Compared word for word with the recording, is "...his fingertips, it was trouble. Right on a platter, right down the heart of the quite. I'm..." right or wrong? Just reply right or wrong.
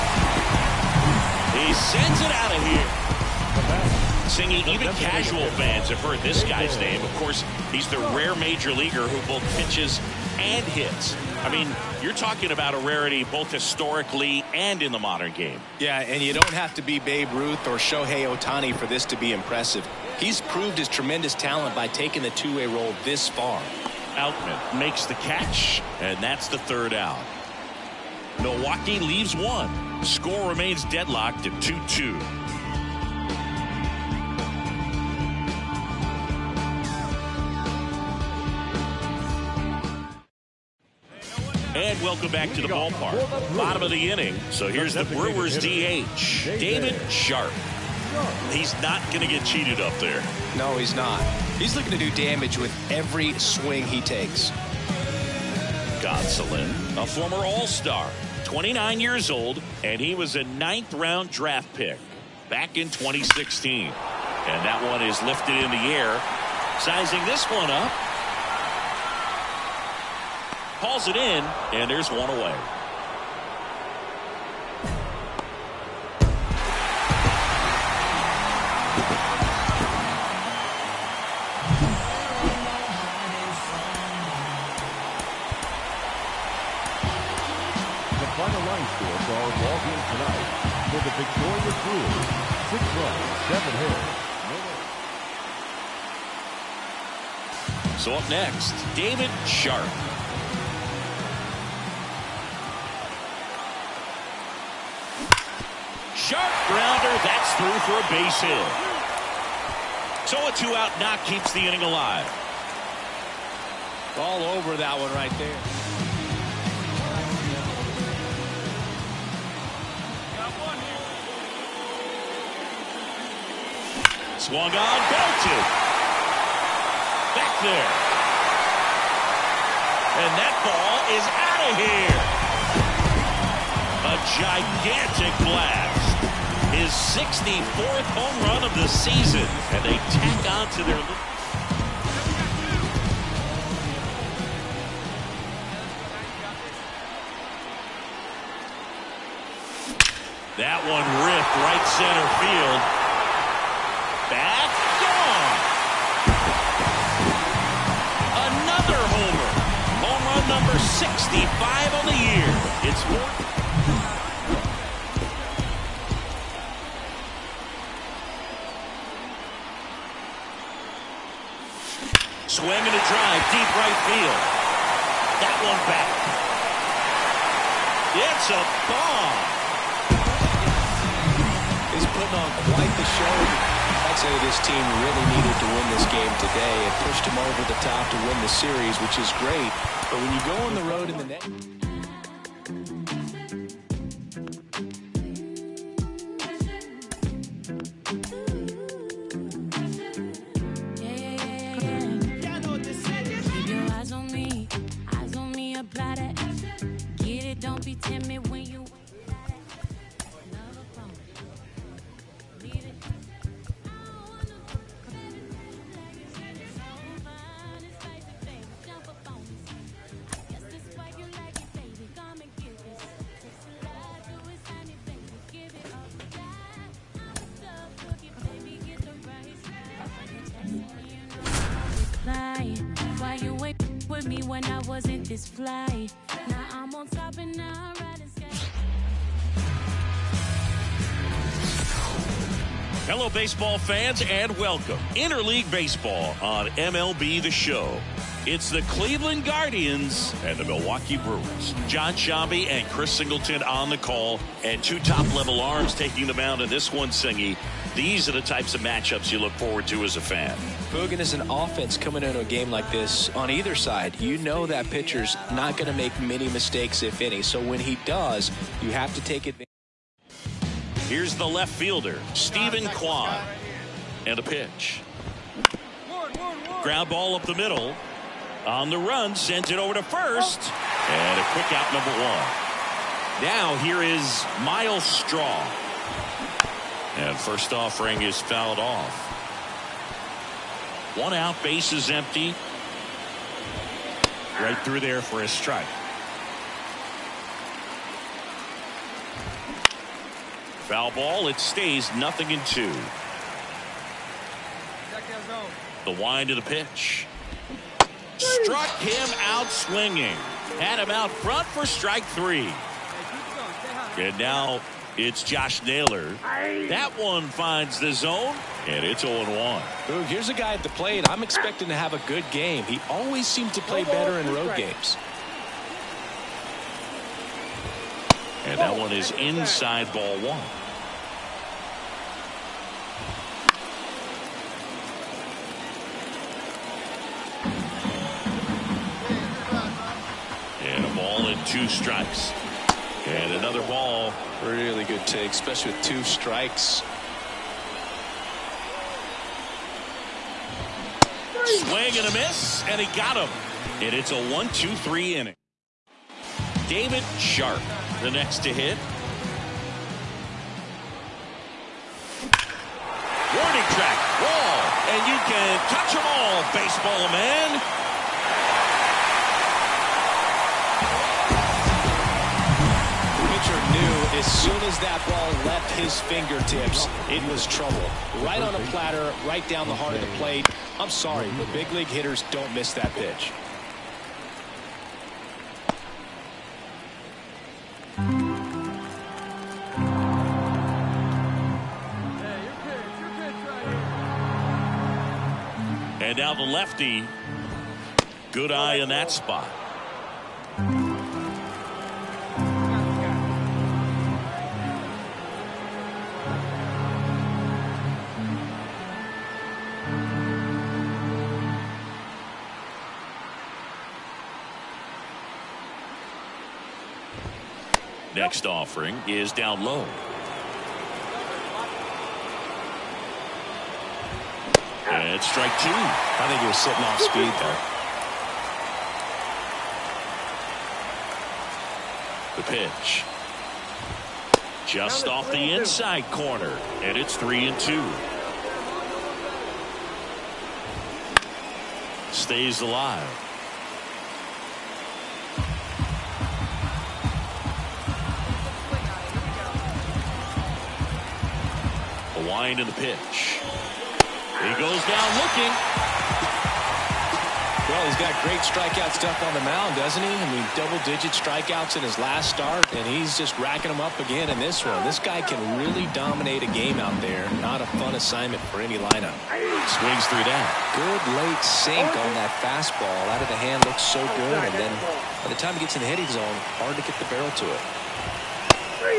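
wrong.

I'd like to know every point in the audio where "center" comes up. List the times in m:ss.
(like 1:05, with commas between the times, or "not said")
2:31.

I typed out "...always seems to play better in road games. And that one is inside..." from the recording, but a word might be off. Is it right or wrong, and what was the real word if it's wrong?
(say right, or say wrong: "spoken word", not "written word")
right.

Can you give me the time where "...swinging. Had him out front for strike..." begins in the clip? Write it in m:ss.
5:09.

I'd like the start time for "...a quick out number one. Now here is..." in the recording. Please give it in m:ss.
4:41.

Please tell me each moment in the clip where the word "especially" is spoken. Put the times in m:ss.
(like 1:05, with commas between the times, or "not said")
5:45.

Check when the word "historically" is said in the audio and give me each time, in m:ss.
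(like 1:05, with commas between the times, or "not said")
0:13.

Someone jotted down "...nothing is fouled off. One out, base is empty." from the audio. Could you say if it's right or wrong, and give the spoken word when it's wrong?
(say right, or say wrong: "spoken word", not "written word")
wrong: "offering", not "nothing".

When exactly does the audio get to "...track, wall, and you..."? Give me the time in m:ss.
6:03.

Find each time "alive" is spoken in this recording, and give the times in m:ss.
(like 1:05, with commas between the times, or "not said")
1:51, 7:22.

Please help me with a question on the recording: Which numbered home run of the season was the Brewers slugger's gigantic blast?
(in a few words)
64th.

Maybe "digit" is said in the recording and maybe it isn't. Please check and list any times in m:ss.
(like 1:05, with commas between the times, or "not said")
7:40.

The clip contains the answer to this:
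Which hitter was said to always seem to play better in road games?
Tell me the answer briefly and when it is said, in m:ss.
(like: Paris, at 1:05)
Josh Naylor, at 5:15.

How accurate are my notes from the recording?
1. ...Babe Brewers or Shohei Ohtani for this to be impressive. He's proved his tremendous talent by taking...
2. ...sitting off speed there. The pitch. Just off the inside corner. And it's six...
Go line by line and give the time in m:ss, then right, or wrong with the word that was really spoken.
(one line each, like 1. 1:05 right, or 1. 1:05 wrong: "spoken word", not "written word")
1. 0:16 wrong: "Ruth", not "Brewers"
2. 7:06 wrong: "three", not "six".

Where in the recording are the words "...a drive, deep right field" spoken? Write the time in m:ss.
2:52.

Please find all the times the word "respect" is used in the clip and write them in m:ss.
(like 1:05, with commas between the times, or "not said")
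not said.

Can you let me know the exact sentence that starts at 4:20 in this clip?
Bogan is an offense coming into a game like this on either side.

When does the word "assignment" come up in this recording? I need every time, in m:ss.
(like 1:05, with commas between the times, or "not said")
7:48.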